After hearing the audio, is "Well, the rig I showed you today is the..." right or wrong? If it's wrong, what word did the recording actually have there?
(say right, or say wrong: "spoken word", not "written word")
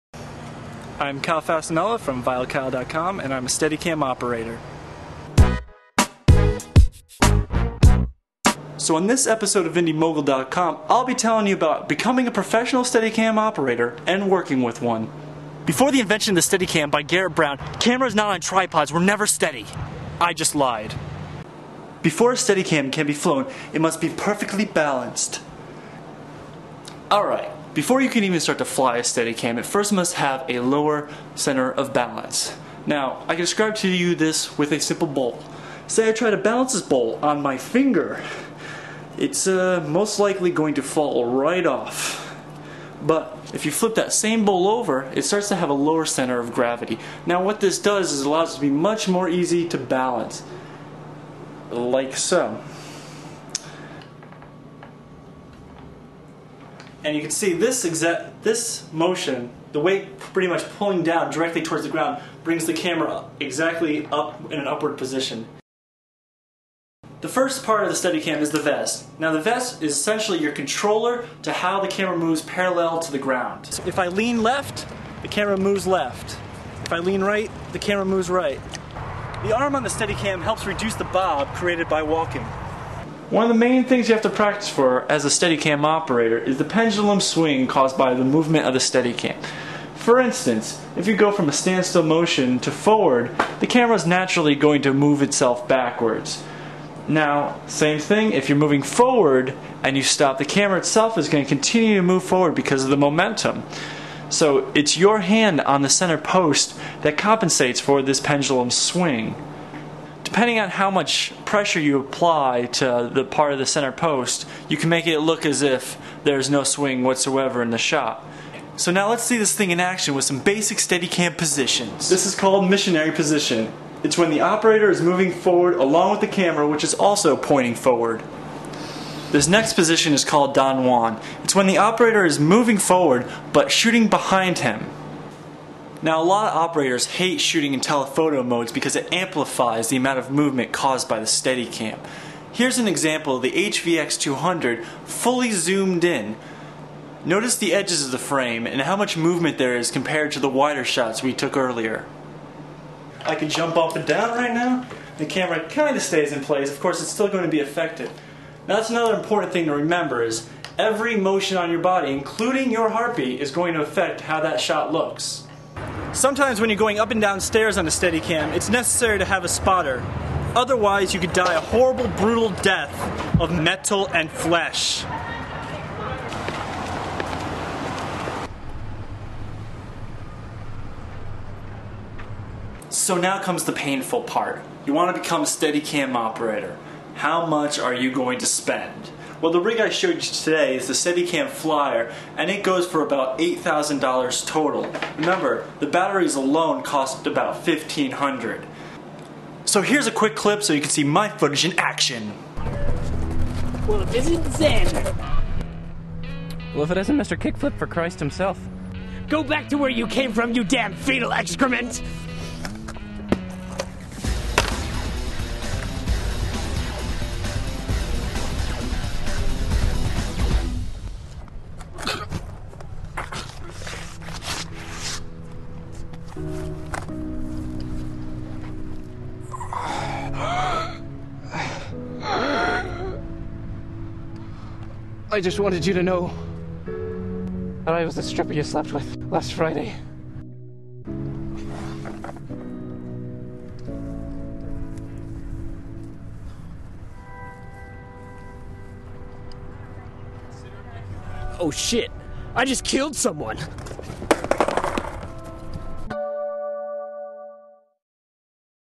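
right.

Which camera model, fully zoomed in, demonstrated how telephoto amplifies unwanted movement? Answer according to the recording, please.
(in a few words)
HVX200.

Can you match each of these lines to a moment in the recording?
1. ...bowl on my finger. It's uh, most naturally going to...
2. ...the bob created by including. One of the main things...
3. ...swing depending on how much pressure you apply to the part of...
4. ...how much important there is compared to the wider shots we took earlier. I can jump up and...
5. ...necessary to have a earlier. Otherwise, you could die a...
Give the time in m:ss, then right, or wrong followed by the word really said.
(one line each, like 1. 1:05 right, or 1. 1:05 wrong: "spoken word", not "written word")
1. 0:36 wrong: "likely", not "naturally"
2. 1:20 wrong: "walking", not "including"
3. 1:48 right
4. 2:28 wrong: "movement", not "important"
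5. 2:48 wrong: "spotter", not "earlier".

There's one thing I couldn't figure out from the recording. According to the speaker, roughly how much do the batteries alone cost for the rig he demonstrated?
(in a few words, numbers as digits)
$1,500.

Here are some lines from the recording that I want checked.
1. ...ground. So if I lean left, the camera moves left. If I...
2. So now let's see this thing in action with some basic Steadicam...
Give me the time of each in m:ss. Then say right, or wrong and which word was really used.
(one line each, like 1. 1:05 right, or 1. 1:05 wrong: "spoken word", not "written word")
1. 1:13 right
2. 1:58 right.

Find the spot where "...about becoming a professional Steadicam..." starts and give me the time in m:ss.
0:11.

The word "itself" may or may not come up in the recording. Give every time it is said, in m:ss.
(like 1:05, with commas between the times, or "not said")
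1:35, 1:40.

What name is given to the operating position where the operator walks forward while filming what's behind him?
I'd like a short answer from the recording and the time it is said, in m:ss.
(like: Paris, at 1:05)
Don Juan, at 2:10.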